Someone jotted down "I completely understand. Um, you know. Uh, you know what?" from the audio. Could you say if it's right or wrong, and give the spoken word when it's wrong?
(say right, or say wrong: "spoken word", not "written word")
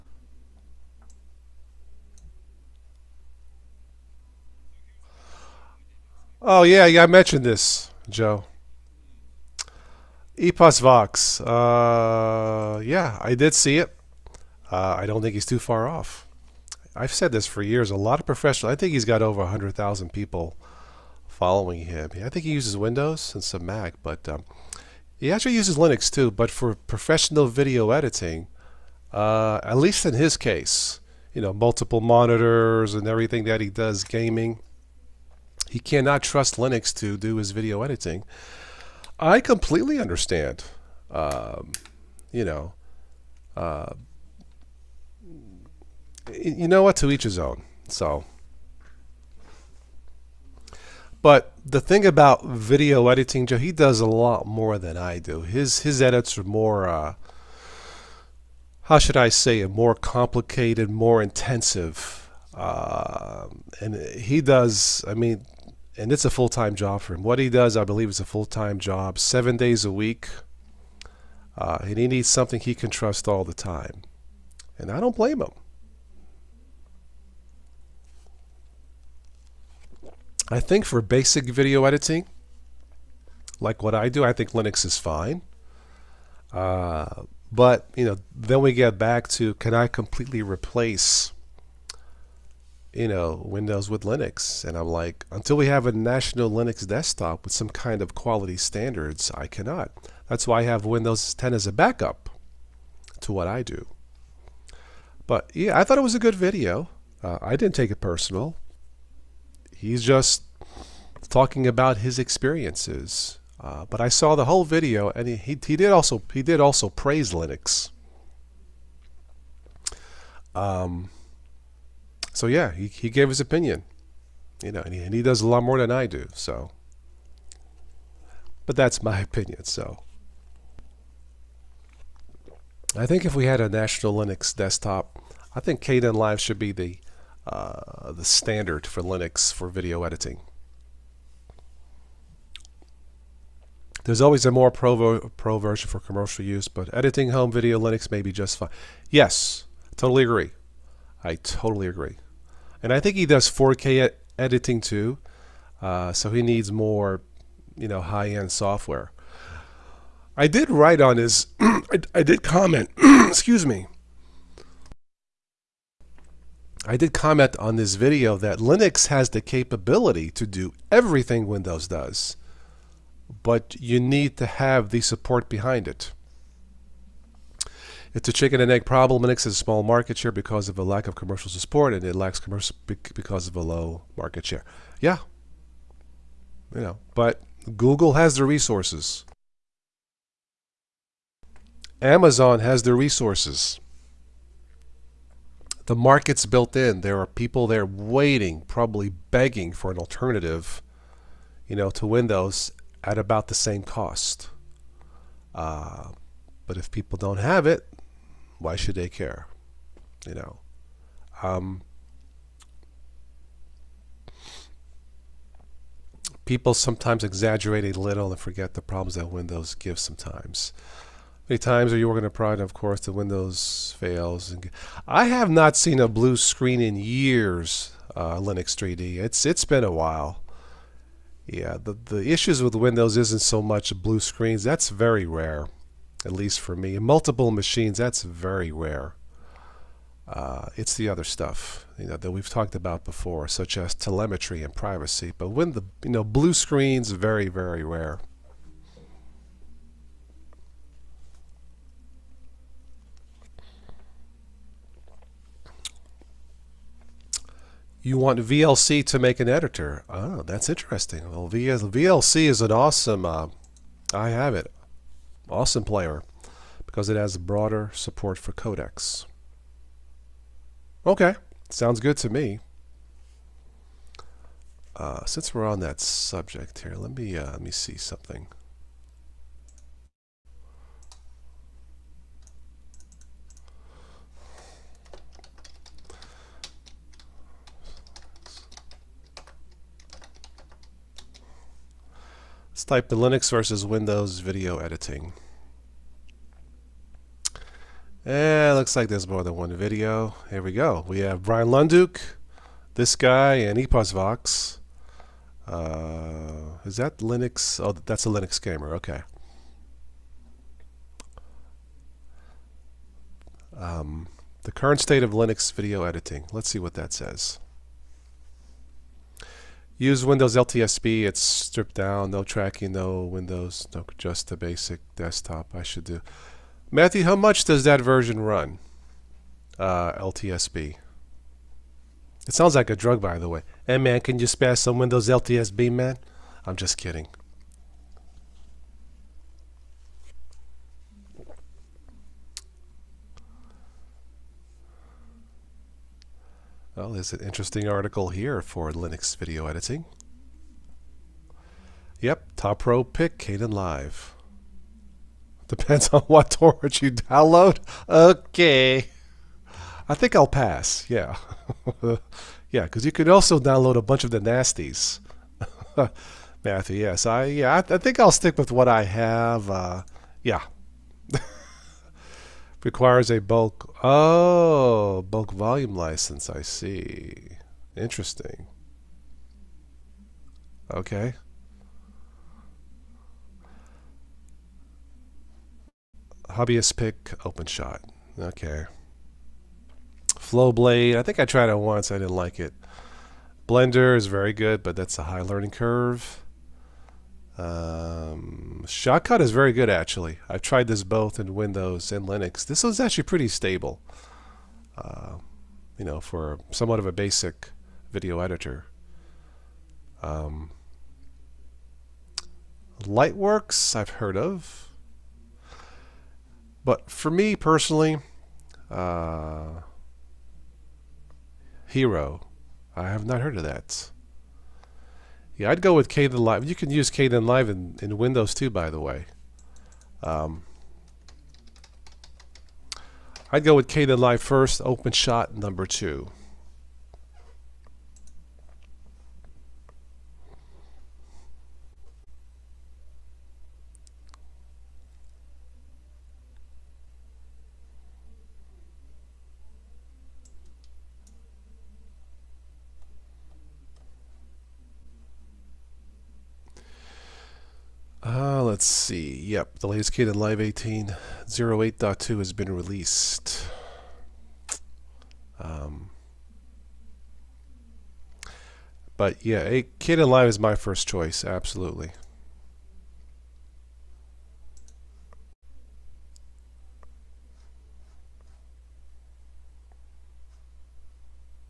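right.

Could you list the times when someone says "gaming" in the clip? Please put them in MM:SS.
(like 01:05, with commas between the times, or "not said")
00:34.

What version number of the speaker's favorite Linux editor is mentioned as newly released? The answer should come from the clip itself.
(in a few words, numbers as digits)
18.08.2.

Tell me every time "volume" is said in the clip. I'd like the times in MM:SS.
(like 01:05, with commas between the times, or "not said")
06:15.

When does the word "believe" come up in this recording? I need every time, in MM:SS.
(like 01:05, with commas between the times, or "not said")
01:07.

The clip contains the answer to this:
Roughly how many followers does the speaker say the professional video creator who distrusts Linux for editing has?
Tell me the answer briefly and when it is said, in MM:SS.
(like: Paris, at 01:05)
over 100,000, at 00:19.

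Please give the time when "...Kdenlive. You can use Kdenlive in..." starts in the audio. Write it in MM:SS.
07:06.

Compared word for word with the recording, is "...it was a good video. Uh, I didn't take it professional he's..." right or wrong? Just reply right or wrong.
wrong.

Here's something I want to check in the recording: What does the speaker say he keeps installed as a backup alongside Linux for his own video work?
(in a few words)
Windows 10.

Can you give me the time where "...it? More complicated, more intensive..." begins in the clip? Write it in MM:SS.
00:59.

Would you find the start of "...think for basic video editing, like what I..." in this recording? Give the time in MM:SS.
01:20.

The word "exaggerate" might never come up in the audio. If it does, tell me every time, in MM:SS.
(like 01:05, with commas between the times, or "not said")
03:37.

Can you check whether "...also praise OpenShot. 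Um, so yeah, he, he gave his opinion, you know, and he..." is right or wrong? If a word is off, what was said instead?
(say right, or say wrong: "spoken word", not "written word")
wrong: "Linux", not "OpenShot".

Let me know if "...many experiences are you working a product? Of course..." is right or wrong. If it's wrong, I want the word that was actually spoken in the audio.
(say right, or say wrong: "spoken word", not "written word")
wrong: "times", not "experiences".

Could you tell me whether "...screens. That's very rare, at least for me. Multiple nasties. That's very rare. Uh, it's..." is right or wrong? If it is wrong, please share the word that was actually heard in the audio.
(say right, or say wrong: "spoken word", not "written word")
wrong: "machines", not "nasties".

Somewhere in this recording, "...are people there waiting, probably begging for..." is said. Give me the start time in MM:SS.
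03:17.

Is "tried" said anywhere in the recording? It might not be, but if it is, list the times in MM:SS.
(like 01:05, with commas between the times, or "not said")
06:31, 06:40.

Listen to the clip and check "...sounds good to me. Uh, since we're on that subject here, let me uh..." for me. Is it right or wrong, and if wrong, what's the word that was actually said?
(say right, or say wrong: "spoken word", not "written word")
right.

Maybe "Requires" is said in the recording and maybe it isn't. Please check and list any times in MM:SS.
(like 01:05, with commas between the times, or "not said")
06:12.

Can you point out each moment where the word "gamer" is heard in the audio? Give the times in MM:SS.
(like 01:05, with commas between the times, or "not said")
05:08.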